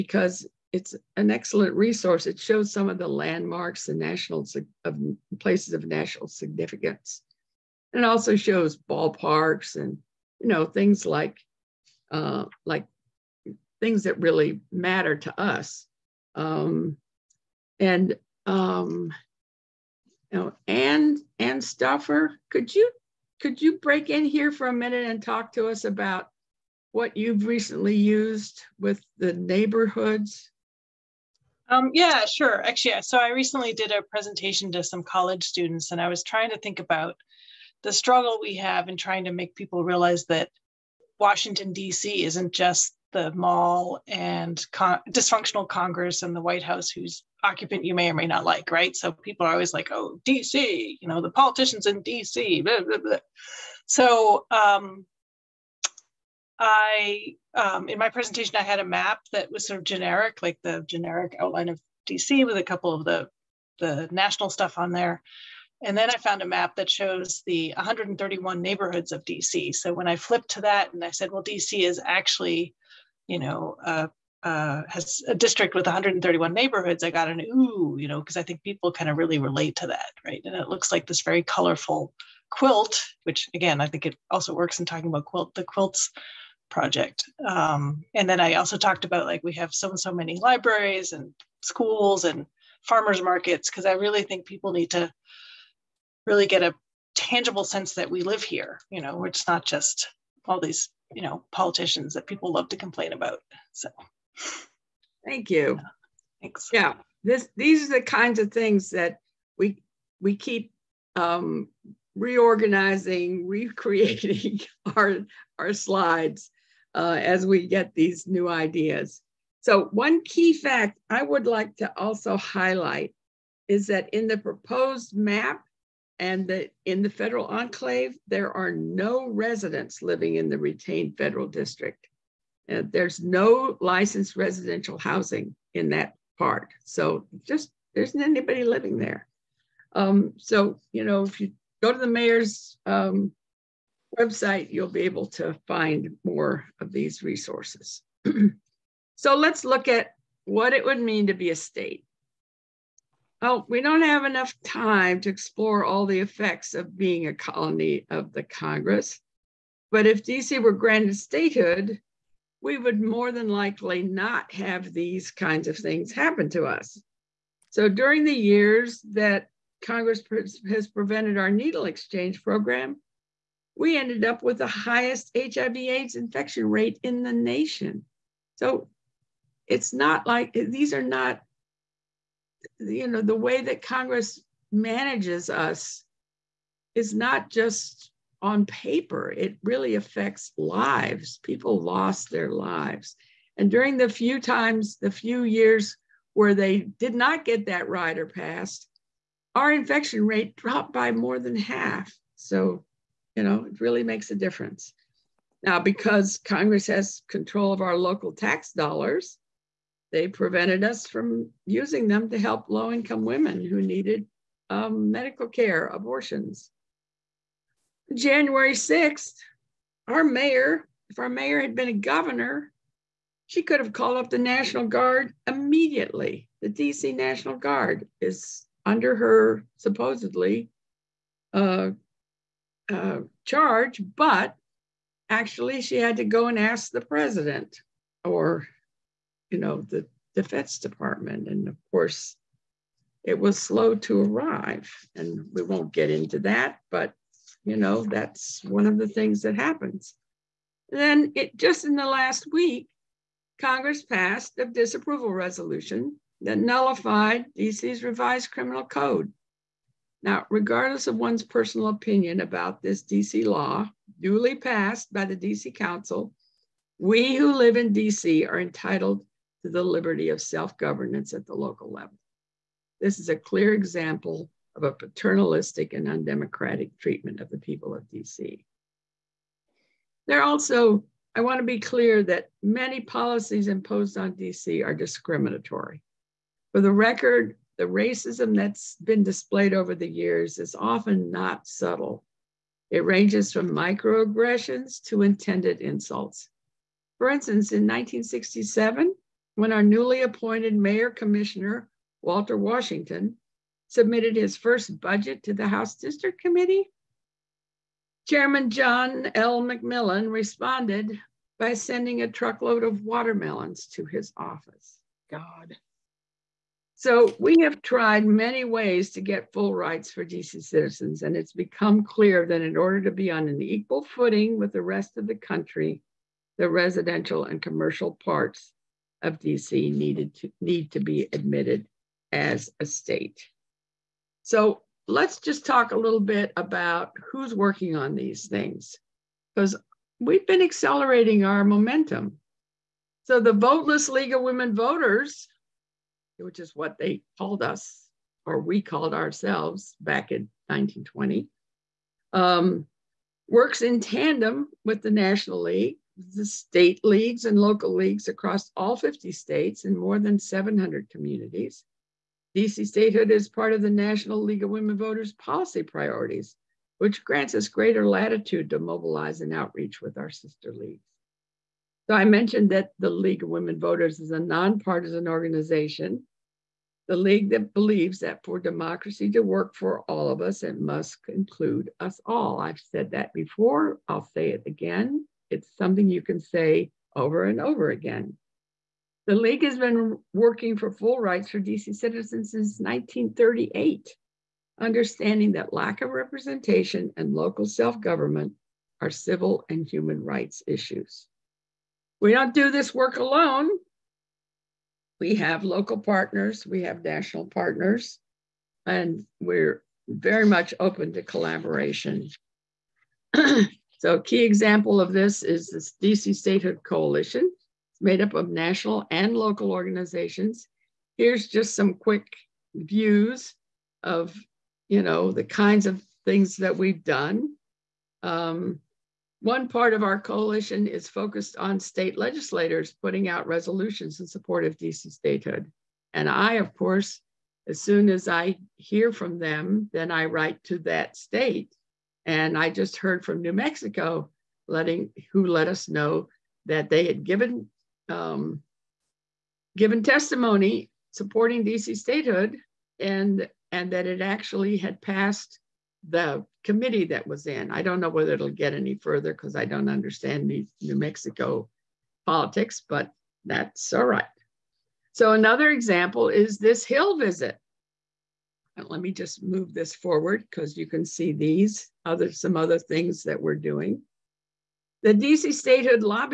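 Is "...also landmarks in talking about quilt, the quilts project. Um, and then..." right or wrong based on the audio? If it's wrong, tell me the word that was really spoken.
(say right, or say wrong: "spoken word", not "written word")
wrong: "works", not "landmarks".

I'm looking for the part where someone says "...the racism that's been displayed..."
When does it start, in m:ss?
4:47.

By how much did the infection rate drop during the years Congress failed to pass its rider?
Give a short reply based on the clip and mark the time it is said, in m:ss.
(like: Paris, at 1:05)
more than half, at 3:21.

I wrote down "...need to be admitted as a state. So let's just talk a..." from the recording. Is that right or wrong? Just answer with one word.
right.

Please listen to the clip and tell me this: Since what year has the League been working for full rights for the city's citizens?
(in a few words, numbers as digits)
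1938.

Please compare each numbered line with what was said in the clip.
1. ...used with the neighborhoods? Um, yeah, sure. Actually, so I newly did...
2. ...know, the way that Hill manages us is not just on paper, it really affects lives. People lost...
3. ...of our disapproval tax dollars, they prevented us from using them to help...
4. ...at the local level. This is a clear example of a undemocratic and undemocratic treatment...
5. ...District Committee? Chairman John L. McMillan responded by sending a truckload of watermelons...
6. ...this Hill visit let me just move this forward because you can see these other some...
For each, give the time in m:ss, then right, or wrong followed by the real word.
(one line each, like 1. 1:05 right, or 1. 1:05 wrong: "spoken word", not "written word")
1. 0:27 wrong: "recently", not "newly"
2. 3:03 wrong: "Congress", not "Hill"
3. 3:27 wrong: "local", not "disapproval"
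4. 4:31 wrong: "paternalistic", not "undemocratic"
5. 5:05 right
6. 7:46 right.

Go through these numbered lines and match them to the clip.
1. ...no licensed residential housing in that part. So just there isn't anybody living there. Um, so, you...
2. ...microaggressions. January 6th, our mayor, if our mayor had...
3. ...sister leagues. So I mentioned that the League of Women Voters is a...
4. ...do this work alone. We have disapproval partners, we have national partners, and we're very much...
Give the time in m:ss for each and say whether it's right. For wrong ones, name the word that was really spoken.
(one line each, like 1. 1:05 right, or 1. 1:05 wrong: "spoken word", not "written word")
1. 2:13 right
2. 3:35 wrong: "abortions", not "microaggressions"
3. 6:10 right
4. 6:42 wrong: "local", not "disapproval".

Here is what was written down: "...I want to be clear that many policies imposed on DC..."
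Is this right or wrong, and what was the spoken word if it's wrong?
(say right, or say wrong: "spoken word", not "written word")
right.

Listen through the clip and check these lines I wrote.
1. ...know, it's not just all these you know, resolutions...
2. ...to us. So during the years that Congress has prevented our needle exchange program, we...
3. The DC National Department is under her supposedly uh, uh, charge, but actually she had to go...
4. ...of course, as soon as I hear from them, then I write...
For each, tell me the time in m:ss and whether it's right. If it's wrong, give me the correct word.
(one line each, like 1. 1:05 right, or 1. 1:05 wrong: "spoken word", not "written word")
1. 1:39 wrong: "politicians", not "resolutions"
2. 2:46 right
3. 3:46 wrong: "Guard", not "Department"
4. 7:16 right.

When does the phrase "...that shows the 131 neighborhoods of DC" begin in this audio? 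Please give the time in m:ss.
1:06.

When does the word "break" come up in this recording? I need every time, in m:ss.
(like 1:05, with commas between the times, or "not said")
0:23.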